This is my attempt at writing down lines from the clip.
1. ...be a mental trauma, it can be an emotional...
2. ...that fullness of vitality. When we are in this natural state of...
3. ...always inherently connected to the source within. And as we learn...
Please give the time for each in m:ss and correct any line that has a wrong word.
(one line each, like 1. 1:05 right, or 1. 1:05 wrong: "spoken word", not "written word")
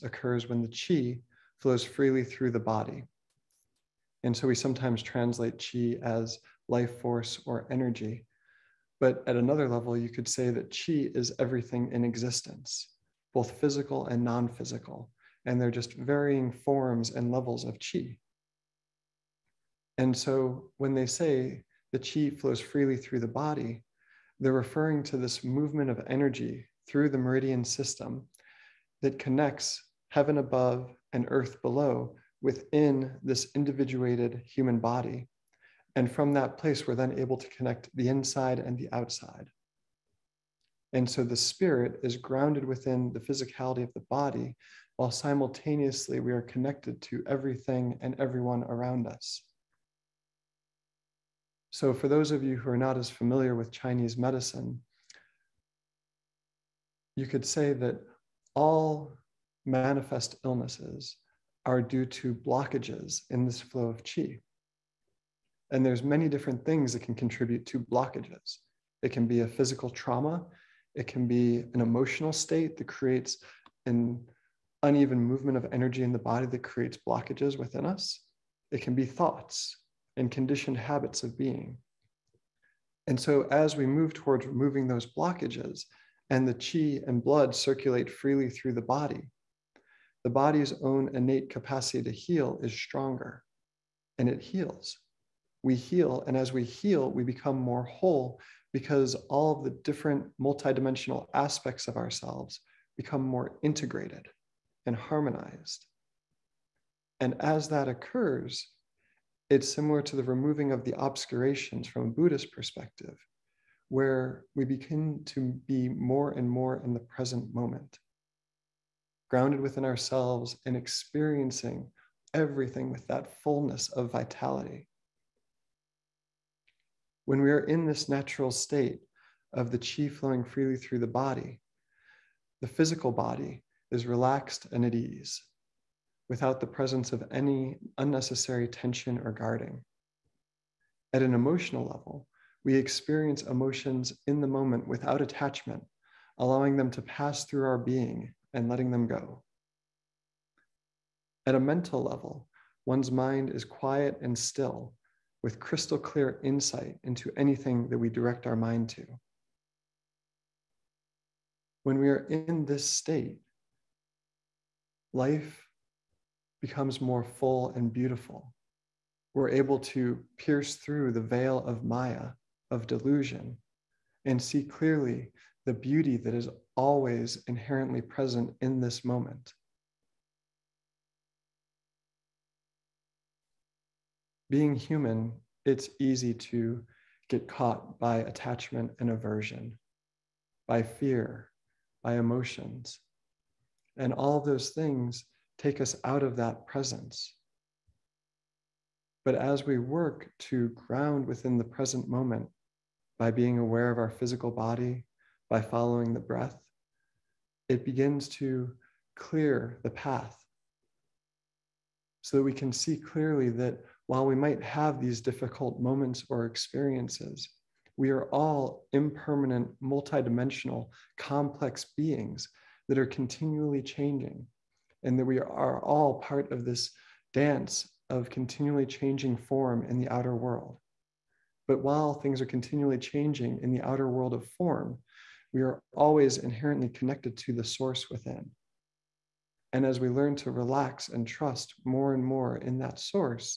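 1. 1:09 wrong: "physical", not "mental"
2. 2:03 right
3. 3:55 right.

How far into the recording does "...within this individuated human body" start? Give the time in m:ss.
0:32.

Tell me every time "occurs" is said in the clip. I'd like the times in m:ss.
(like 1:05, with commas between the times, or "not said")
0:00, 1:47.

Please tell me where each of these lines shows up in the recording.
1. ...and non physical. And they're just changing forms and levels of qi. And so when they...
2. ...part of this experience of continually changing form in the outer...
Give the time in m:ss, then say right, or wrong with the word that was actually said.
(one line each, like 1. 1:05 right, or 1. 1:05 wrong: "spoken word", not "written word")
1. 0:14 wrong: "varying", not "changing"
2. 3:46 wrong: "dance", not "experience".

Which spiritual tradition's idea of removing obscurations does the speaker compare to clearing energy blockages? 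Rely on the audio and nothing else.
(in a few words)
Buddhist.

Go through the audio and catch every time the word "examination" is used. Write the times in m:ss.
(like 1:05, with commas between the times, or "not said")
not said.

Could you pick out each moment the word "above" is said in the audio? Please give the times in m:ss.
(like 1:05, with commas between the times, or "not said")
0:30.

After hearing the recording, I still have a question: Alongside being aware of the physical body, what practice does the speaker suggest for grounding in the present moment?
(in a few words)
following the breath.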